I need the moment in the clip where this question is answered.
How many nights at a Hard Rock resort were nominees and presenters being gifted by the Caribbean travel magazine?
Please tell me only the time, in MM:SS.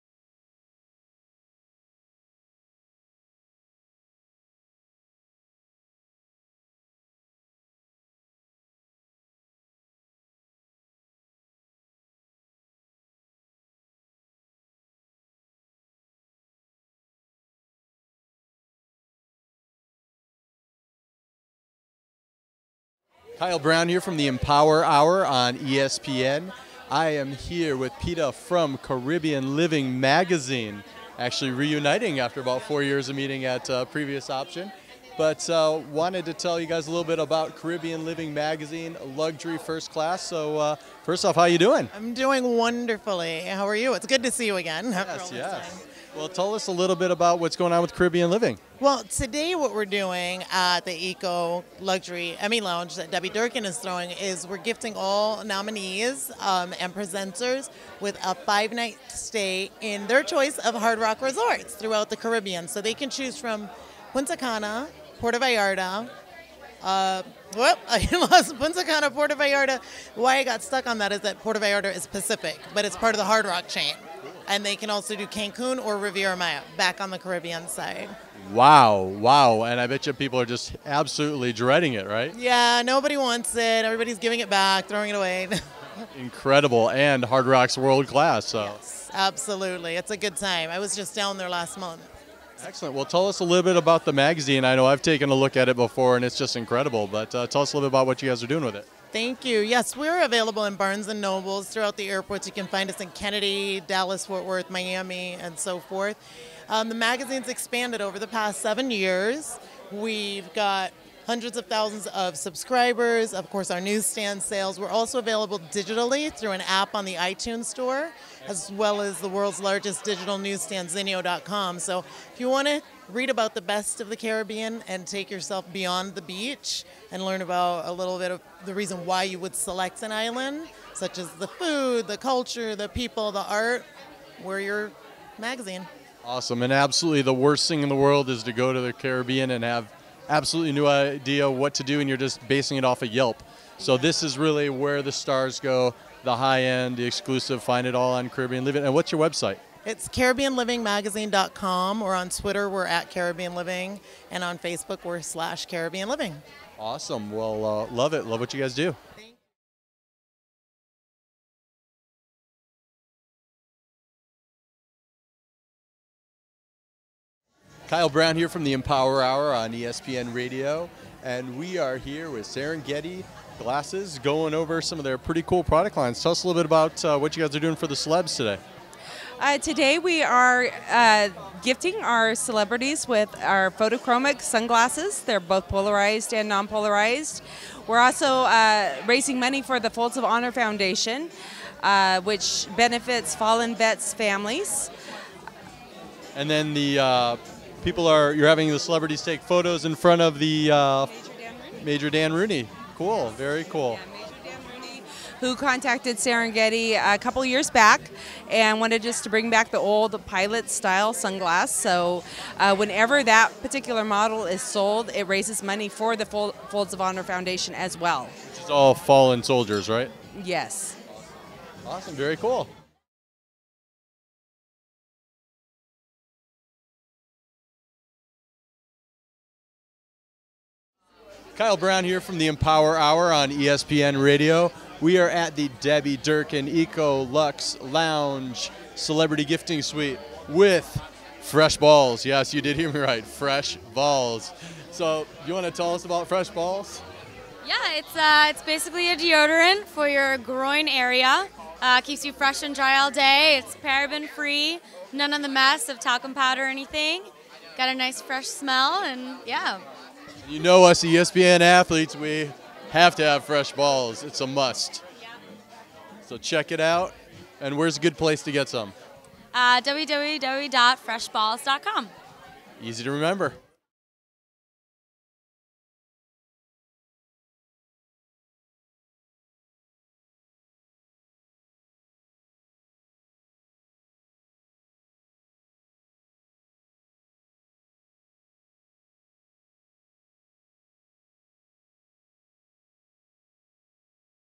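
00:58.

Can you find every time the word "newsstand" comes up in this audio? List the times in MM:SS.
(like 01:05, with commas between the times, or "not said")
01:53, 02:00.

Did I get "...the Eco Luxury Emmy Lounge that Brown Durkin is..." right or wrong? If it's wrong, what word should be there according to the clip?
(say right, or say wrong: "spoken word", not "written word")
wrong: "Debbie", not "Brown".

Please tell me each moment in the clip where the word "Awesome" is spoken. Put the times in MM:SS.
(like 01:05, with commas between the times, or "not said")
02:16, 02:36, 03:41.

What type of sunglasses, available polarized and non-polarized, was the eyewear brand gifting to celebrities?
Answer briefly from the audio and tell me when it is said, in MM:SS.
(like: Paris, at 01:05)
Photochromic, at 03:03.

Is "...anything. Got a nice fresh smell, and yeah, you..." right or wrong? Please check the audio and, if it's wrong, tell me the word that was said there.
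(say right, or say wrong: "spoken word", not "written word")
right.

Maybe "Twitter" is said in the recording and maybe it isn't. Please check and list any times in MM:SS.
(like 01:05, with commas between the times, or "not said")
02:32.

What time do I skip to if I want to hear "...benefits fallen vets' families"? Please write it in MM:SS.
03:12.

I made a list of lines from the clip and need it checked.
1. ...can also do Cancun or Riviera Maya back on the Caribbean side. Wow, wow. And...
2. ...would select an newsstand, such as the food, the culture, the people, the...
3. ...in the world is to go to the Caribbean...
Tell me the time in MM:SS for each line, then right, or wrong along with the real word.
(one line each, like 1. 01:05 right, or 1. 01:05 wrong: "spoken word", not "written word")
1. 01:14 right
2. 02:09 wrong: "island", not "newsstand"
3. 02:17 right.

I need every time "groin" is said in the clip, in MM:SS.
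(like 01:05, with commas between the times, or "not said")
04:10.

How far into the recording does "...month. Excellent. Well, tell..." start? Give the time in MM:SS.
01:31.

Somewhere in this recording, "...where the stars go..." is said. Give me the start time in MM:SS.
02:24.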